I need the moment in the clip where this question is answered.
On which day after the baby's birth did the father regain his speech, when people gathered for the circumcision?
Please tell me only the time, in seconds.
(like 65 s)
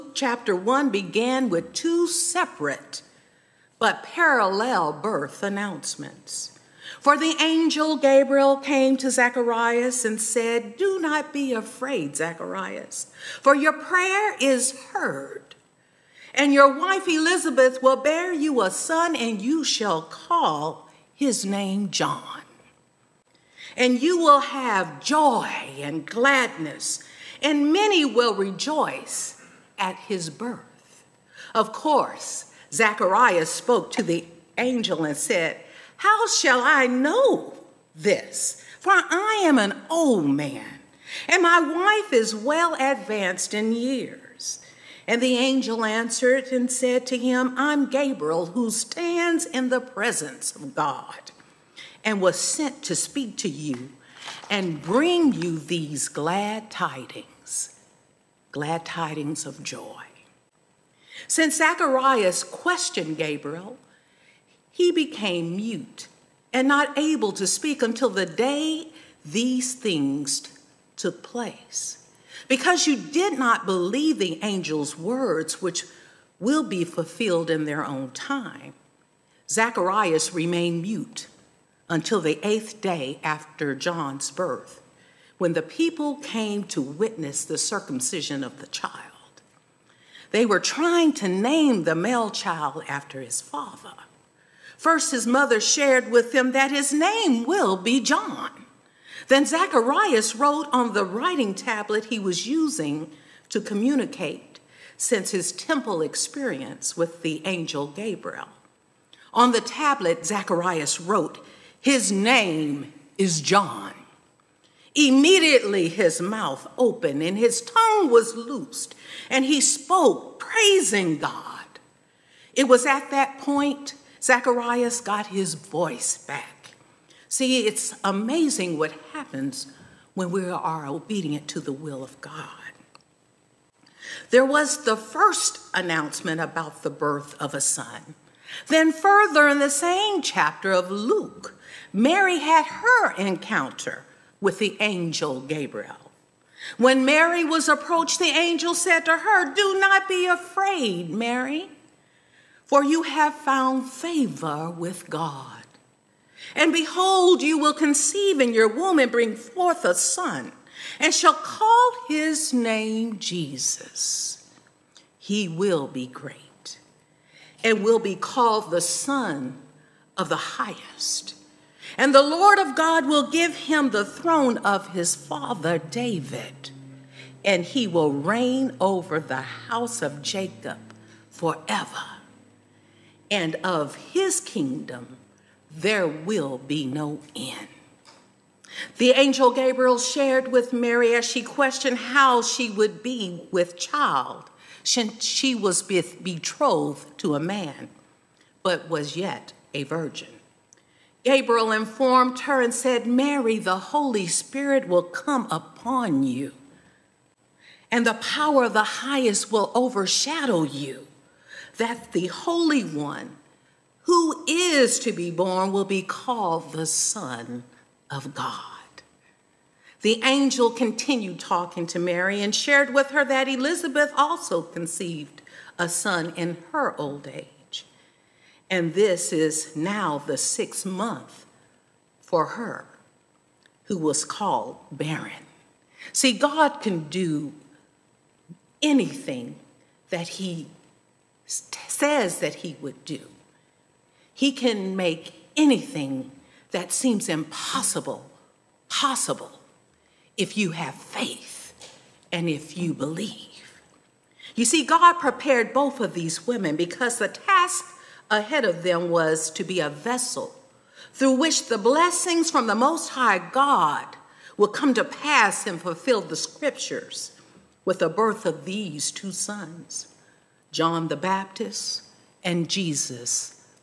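82 s.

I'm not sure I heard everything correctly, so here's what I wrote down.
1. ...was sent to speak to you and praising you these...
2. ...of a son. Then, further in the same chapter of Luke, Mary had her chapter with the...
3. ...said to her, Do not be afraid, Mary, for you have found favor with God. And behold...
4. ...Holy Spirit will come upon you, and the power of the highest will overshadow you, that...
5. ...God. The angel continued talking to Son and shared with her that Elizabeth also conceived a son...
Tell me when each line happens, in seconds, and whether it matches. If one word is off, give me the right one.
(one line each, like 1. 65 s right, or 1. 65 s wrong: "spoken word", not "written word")
1. 52 s wrong: "bring", not "praising"
2. 137 s wrong: "encounter", not "chapter"
3. 148 s right
4. 203 s right
5. 218 s wrong: "Mary", not "Son".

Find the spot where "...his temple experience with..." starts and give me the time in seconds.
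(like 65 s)
105 s.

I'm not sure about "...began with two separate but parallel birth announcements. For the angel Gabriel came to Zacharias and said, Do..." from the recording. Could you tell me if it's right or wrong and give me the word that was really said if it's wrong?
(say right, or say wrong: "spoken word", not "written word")
right.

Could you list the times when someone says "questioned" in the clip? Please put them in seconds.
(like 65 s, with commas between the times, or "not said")
62 s, 191 s.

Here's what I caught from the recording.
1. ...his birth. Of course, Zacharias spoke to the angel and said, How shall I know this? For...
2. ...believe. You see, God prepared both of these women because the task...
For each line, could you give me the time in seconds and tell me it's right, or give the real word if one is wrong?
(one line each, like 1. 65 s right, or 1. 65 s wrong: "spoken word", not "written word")
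1. 29 s right
2. 252 s right.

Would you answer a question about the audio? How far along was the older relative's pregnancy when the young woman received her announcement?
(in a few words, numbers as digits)
6th month.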